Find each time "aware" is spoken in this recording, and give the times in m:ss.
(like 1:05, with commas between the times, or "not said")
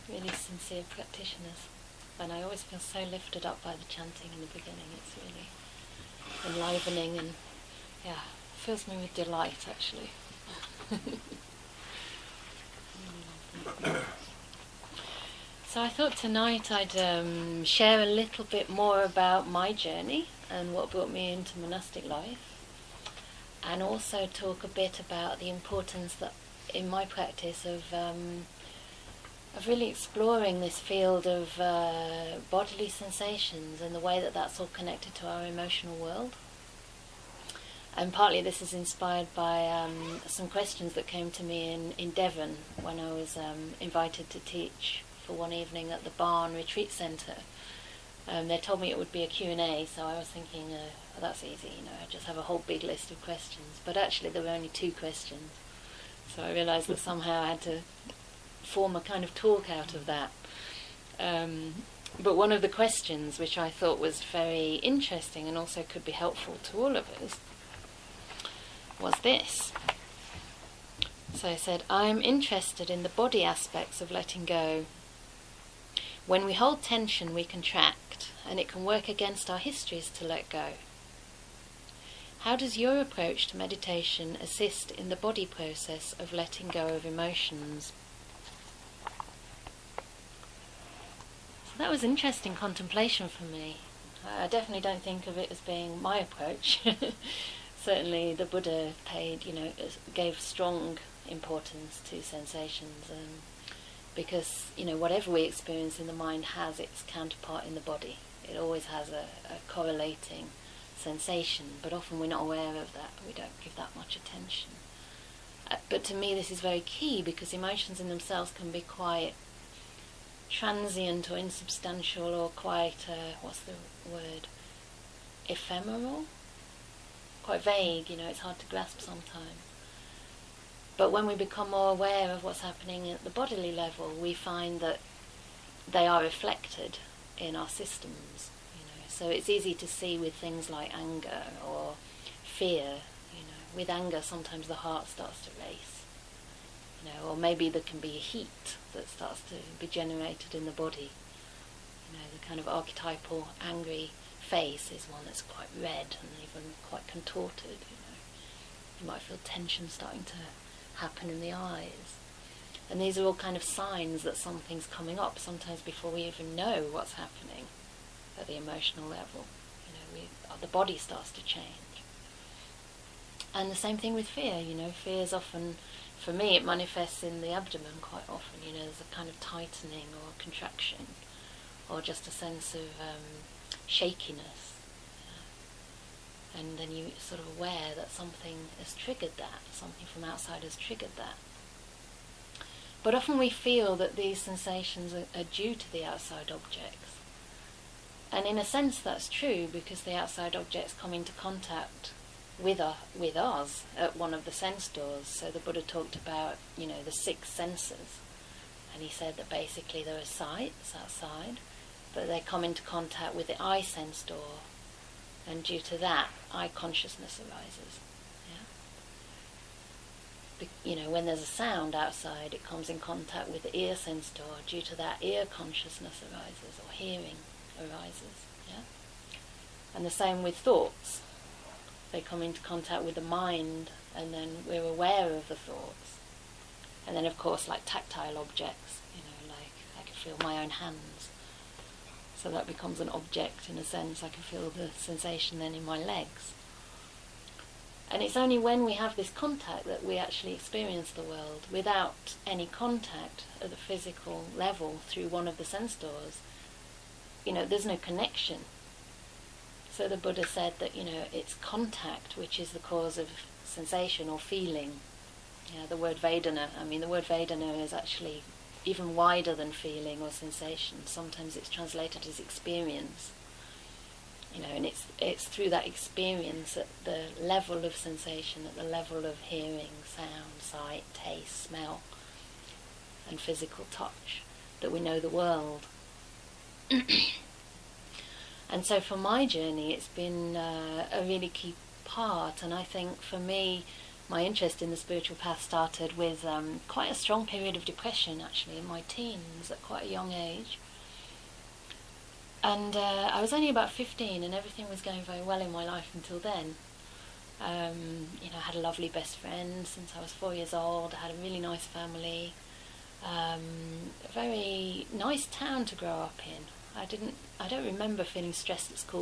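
1:52, 2:11, 3:07, 3:54.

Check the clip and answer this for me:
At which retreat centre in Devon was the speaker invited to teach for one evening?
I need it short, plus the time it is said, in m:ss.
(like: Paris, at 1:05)
The Barn Retreat Centre, at 0:46.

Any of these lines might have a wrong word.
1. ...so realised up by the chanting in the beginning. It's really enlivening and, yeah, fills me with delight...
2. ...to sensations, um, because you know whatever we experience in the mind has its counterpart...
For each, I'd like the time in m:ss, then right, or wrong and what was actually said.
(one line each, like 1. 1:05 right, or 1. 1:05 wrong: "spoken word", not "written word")
1. 0:02 wrong: "lifted", not "realised"
2. 1:42 right.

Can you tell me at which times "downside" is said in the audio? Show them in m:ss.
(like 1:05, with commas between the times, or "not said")
not said.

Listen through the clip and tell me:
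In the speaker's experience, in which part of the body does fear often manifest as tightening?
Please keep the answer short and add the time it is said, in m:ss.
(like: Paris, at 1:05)
The abdomen, at 2:57.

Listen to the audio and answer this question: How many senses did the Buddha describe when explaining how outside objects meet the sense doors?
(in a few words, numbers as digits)
6.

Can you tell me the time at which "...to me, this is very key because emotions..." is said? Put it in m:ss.
1:56.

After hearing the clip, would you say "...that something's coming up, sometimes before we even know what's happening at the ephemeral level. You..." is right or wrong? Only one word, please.
wrong.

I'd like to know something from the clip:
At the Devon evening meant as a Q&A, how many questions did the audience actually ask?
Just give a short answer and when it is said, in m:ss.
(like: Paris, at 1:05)
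2, at 0:54.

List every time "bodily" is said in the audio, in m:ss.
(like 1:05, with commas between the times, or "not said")
0:32, 2:13.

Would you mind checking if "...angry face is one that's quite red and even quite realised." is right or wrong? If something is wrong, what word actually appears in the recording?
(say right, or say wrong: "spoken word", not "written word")
wrong: "contorted", not "realised".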